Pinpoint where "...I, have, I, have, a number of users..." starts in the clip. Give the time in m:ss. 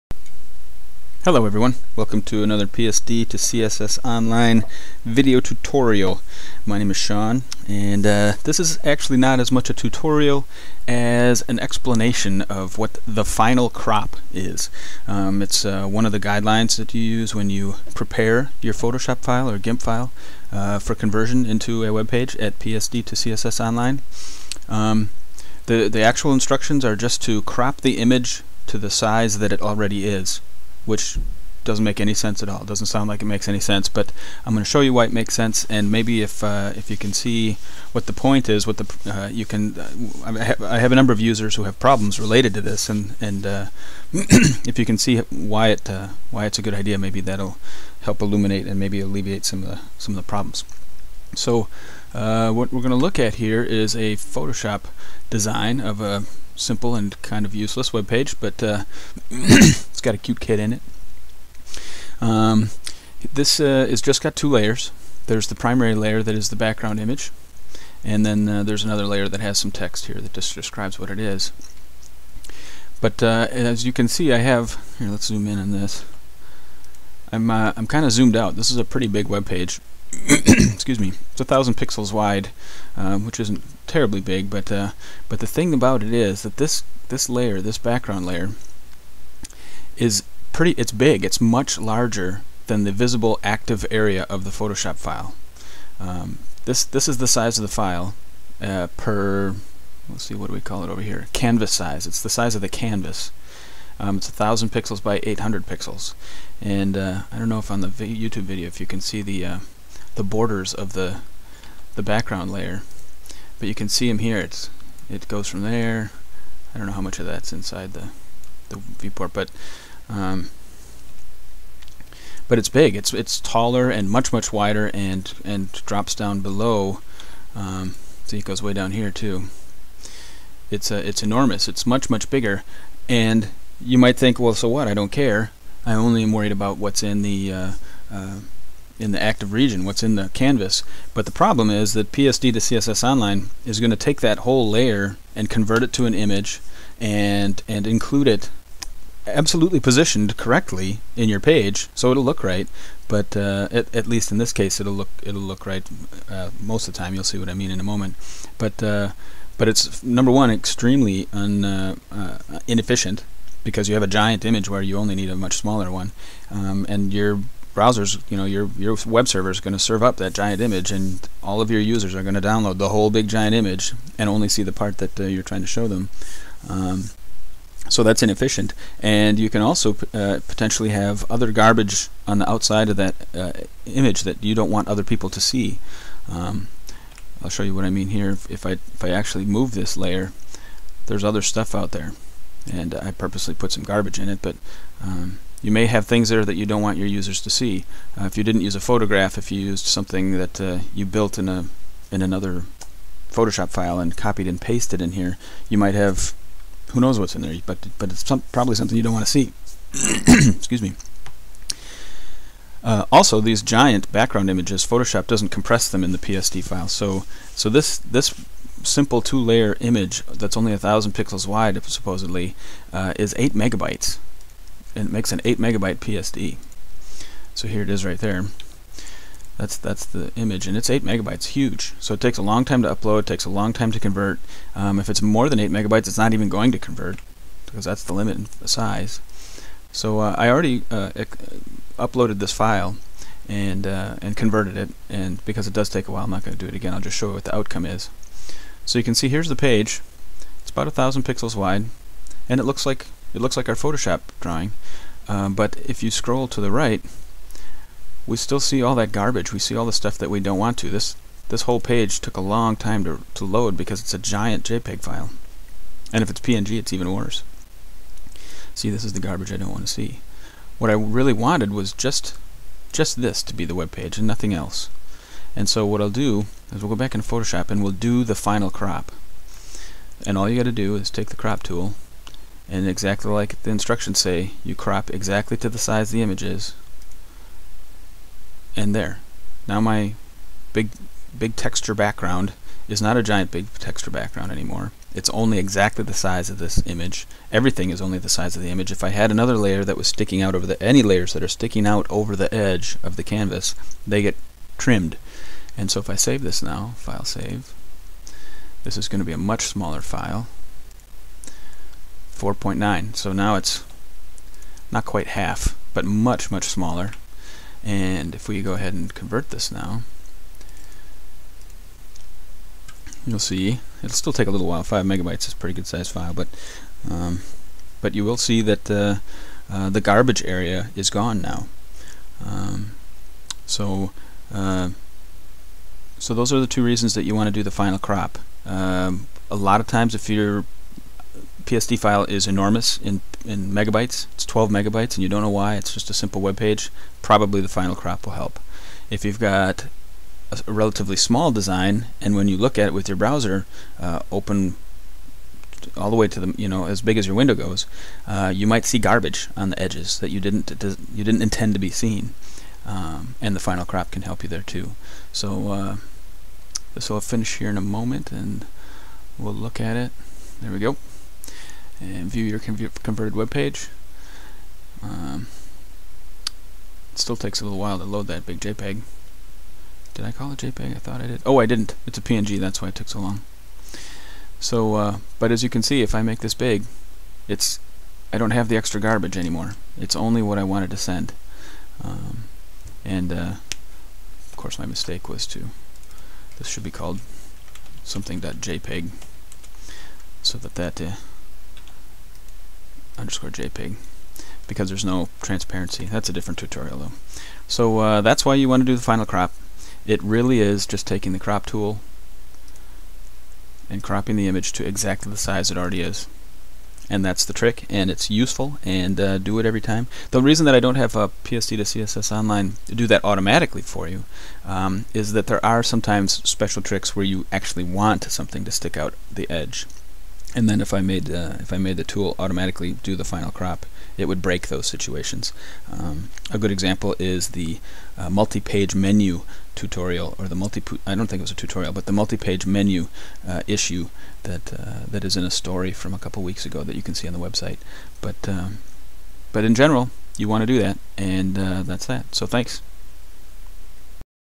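0:40.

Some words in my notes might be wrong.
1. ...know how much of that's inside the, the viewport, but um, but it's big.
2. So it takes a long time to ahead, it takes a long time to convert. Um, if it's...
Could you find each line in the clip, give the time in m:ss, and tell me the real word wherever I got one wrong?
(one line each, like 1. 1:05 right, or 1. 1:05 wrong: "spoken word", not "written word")
1. 1:56 right
2. 3:51 wrong: "upload", not "ahead".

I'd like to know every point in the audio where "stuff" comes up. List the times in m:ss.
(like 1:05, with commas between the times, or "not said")
3:11, 4:19.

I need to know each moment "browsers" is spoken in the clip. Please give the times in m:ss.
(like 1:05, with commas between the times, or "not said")
2:47, 5:53.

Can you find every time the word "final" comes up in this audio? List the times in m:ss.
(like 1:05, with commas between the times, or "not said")
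0:13, 4:38, 5:37, 5:47, 6:03, 6:49, 7:13.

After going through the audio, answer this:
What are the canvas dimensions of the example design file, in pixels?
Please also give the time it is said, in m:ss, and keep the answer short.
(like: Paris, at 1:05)
1,000 by 800, at 1:44.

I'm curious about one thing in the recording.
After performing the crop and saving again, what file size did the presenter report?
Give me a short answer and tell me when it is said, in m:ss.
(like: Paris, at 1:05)
4.9, at 5:12.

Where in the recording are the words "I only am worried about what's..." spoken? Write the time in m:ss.
2:15.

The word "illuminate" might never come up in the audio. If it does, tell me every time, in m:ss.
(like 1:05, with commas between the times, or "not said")
0:48.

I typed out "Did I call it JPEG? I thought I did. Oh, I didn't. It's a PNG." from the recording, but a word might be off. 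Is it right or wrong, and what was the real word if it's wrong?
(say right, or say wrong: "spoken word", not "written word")
right.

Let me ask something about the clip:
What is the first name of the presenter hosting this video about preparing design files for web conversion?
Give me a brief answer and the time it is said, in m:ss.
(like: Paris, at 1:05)
Sean, at 0:06.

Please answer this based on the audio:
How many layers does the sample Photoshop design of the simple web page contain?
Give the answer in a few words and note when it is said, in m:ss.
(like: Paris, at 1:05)
2, at 1:04.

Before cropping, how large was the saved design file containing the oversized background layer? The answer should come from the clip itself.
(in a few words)
8 megabytes.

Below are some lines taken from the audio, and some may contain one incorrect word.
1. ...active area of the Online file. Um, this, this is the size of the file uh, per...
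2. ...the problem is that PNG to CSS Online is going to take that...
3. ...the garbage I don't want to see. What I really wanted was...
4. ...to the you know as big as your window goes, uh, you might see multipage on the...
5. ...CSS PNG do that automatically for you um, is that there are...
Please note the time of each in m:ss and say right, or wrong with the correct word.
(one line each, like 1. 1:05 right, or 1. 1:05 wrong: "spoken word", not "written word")
1. 1:33 wrong: "Photoshop", not "Online"
2. 2:21 wrong: "PSD", not "PNG"
3. 4:29 right
4. 5:56 wrong: "garbage", not "multipage"
5. 7:01 wrong: "Online", not "PNG".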